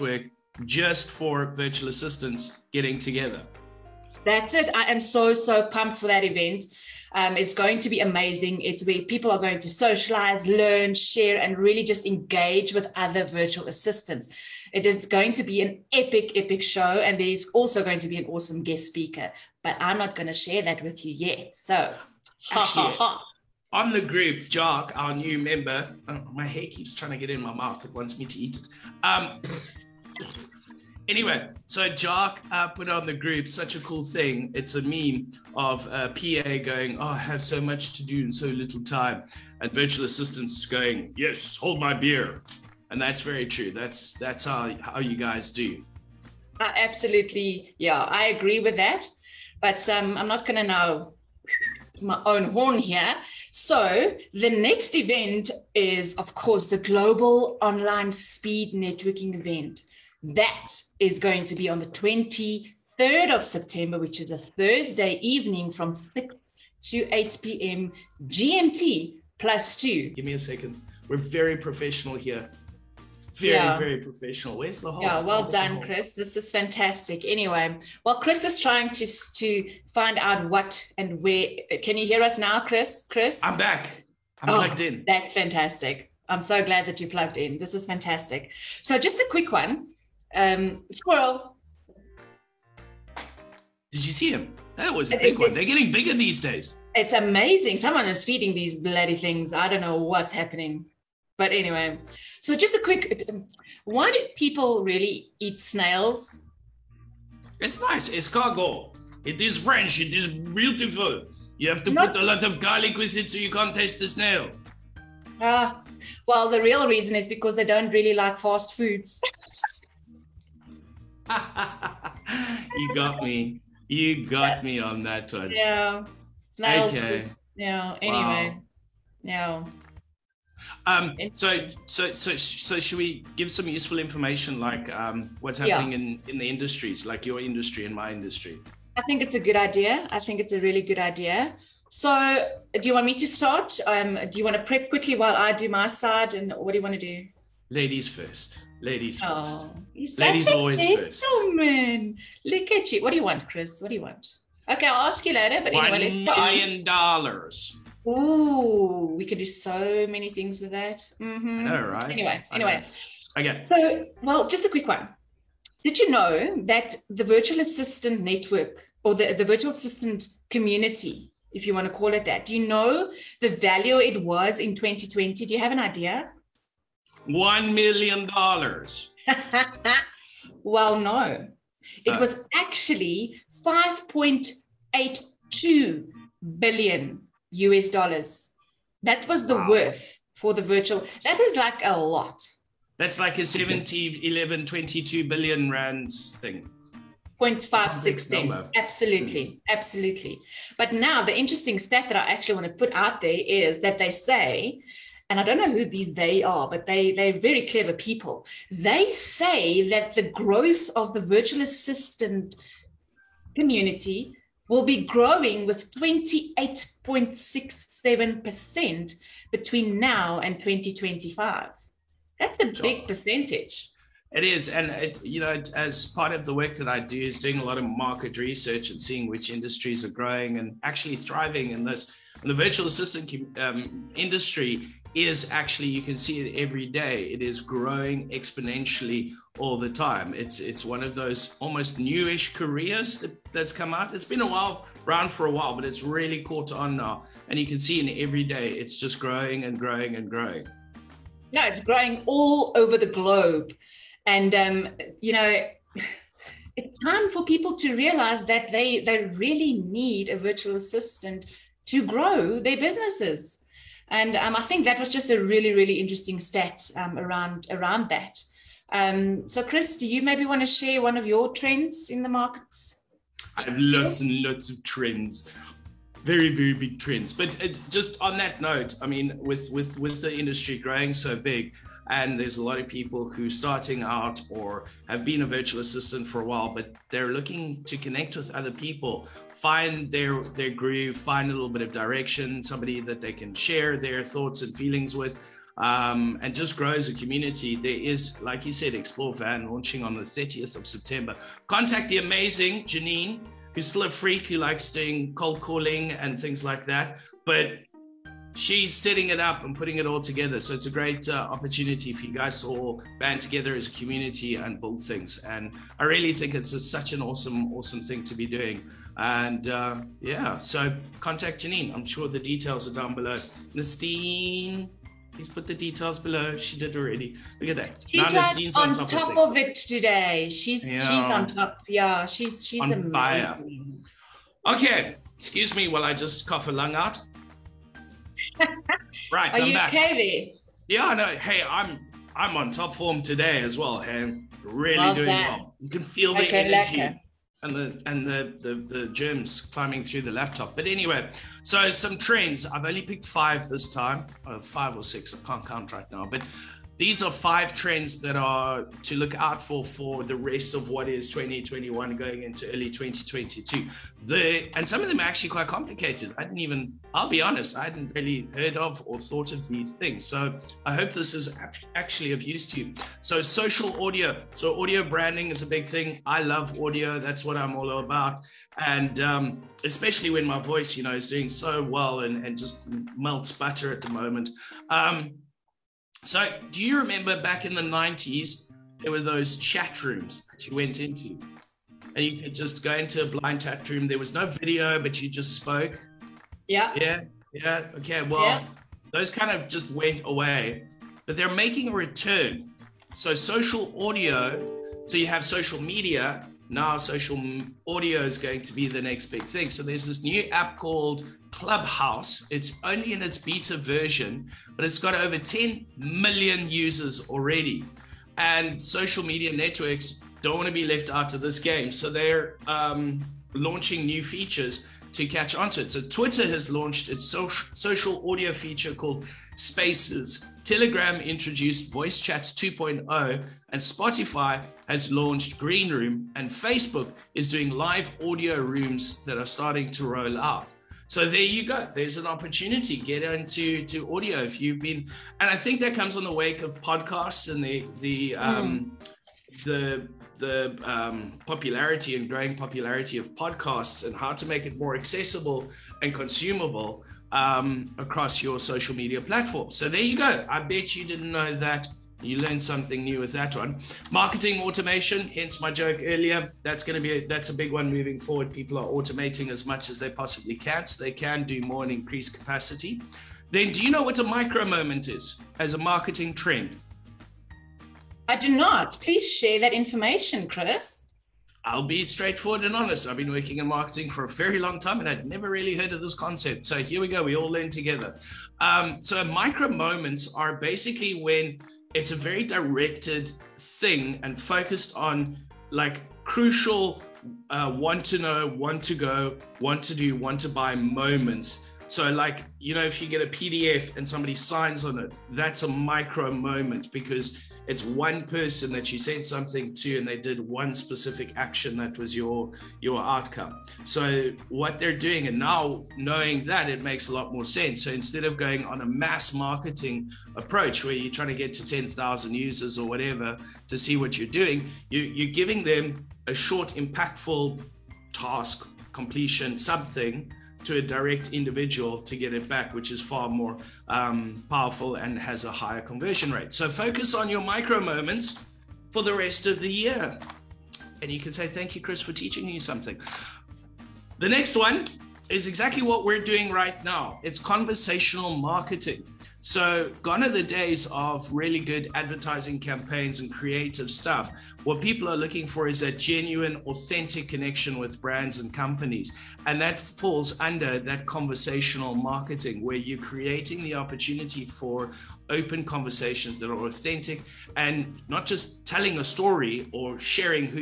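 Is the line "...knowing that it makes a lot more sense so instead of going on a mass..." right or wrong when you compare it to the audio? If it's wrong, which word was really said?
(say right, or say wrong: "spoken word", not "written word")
right.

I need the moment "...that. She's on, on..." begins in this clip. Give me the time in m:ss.
5:27.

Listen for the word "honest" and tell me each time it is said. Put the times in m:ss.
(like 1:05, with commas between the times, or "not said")
6:07, 8:02.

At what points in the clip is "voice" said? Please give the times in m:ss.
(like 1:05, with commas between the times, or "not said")
6:20, 7:11.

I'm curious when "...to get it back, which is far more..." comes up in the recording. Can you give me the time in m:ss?
8:52.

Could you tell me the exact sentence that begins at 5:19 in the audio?
And uh, yeah, so contact Janine.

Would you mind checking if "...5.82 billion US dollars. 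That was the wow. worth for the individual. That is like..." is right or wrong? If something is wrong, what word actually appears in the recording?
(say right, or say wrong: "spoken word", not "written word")
wrong: "virtual", not "individual".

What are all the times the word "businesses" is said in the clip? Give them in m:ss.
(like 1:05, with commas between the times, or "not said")
4:22.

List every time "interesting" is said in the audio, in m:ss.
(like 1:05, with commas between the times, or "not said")
3:21, 4:25.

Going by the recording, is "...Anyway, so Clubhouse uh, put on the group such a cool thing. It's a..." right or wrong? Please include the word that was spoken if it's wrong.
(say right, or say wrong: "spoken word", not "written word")
wrong: "Jock", not "Clubhouse".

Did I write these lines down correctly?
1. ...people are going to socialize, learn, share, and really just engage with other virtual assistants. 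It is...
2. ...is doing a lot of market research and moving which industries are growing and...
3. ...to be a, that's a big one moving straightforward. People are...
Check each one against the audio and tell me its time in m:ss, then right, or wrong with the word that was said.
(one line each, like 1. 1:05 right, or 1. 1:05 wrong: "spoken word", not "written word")
1. 0:09 right
2. 3:47 wrong: "seeing", not "moving"
3. 7:47 wrong: "forward", not "straightforward".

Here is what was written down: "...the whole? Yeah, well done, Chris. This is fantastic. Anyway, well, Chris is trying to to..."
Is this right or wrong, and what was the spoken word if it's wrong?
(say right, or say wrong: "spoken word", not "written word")
right.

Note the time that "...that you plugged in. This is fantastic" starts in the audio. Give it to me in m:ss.
1:26.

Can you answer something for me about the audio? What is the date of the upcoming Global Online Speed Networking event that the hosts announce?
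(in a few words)
23rd of September.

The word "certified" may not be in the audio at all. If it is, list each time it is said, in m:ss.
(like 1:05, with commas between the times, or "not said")
not said.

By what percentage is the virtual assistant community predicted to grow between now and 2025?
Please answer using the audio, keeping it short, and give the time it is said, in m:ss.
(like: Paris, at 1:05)
28.67%, at 3:35.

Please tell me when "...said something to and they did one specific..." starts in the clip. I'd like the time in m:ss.
8:28.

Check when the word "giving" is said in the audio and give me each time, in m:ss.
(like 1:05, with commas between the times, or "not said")
8:45.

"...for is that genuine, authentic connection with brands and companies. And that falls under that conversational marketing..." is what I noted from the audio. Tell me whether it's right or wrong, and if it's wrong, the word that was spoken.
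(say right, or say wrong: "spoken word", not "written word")
right.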